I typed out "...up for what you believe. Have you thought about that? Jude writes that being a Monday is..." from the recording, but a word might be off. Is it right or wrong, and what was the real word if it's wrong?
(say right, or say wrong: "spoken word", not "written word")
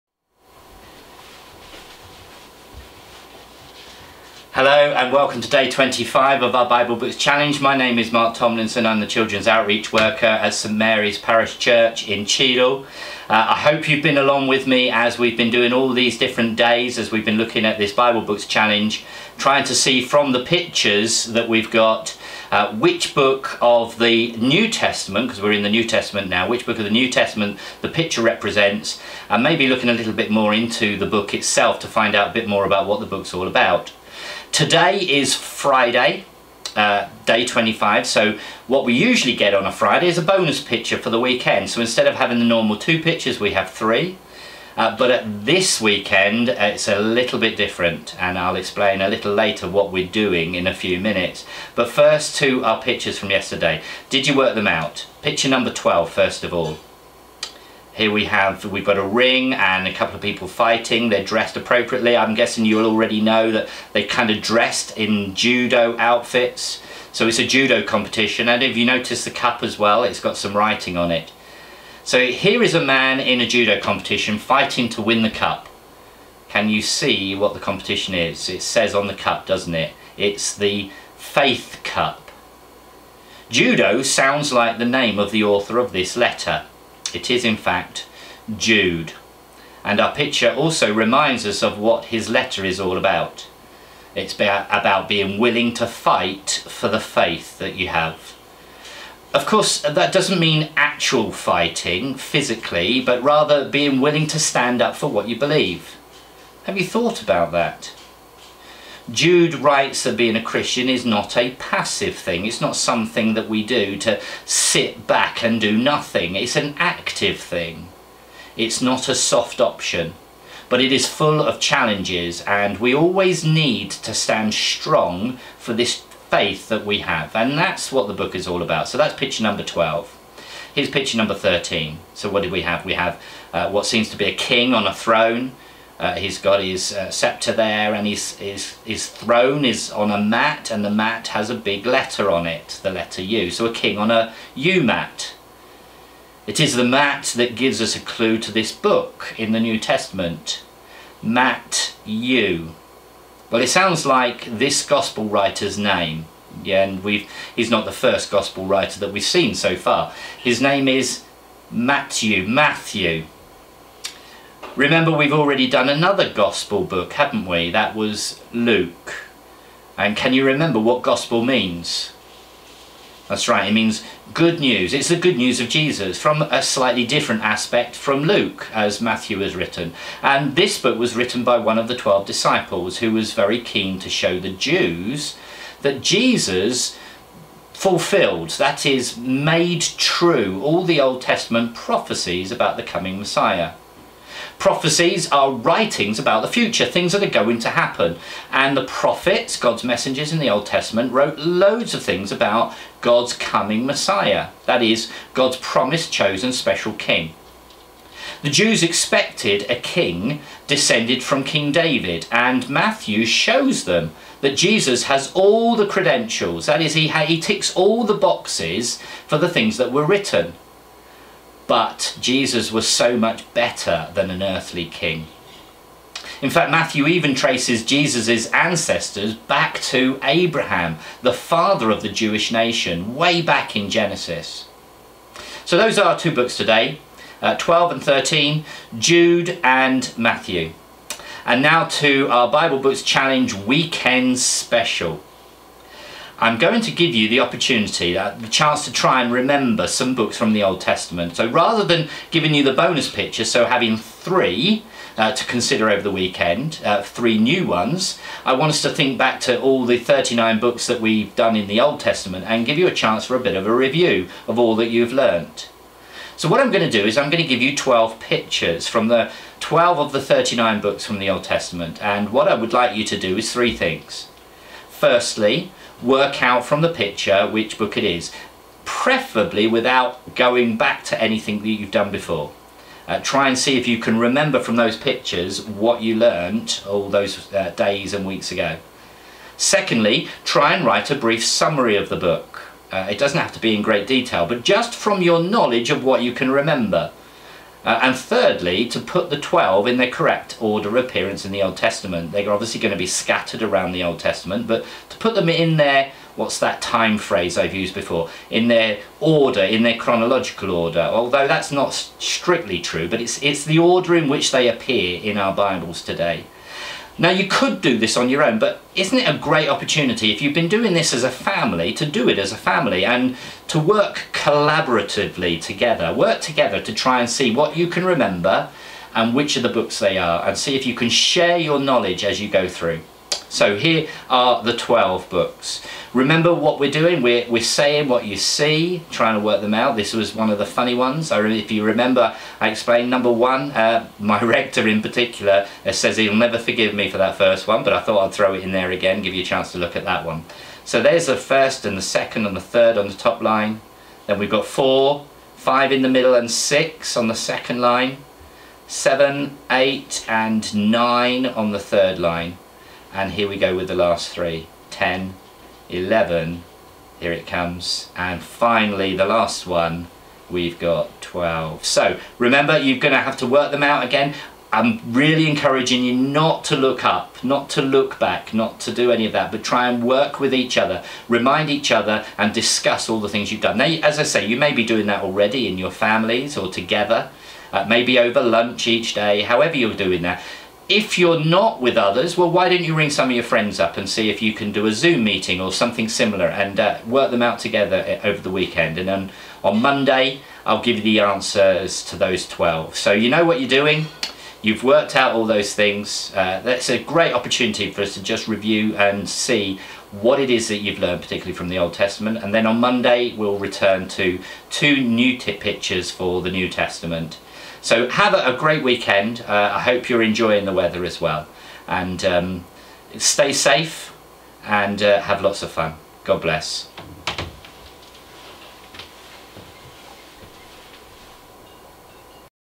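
wrong: "Christian", not "Monday".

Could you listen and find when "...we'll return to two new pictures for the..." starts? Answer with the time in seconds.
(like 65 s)
413 s.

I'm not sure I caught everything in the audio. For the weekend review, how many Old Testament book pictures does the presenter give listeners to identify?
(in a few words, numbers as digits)
12.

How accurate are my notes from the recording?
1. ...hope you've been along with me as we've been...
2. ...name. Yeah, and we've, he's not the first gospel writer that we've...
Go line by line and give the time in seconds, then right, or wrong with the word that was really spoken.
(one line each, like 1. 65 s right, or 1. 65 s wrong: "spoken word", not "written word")
1. 13 s right
2. 155 s right.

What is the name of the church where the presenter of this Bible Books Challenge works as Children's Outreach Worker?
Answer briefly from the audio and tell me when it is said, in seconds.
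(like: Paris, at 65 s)
St Mary's Parish Church, at 10 s.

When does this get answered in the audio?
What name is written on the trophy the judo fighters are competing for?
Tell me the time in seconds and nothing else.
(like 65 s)
80 s.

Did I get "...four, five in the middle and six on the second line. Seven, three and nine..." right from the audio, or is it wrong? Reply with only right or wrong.
wrong.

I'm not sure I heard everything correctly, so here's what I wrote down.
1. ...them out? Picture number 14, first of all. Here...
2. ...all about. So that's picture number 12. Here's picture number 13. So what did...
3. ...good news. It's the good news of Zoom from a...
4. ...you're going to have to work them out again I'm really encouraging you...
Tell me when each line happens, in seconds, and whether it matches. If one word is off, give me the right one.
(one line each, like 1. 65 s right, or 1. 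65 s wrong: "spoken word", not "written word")
1. 54 s wrong: "12", not "14"
2. 128 s right
3. 174 s wrong: "Jesus", not "Zoom"
4. 372 s right.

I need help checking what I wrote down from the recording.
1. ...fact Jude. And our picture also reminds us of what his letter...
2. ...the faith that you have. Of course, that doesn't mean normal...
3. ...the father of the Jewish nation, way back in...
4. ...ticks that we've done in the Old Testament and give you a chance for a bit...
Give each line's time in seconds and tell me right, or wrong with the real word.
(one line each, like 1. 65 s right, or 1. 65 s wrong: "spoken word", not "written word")
1. 87 s right
2. 96 s wrong: "actual", not "normal"
3. 231 s right
4. 260 s wrong: "books", not "ticks".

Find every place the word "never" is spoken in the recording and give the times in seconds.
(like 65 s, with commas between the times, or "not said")
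346 s.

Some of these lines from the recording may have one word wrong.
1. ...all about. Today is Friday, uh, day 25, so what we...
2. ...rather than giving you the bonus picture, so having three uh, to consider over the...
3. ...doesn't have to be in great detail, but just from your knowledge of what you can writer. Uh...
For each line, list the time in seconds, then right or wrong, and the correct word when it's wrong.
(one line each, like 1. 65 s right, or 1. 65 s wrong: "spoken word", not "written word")
1. 33 s right
2. 251 s right
3. 293 s wrong: "remember", not "writer".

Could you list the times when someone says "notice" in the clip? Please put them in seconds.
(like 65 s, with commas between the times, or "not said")
68 s.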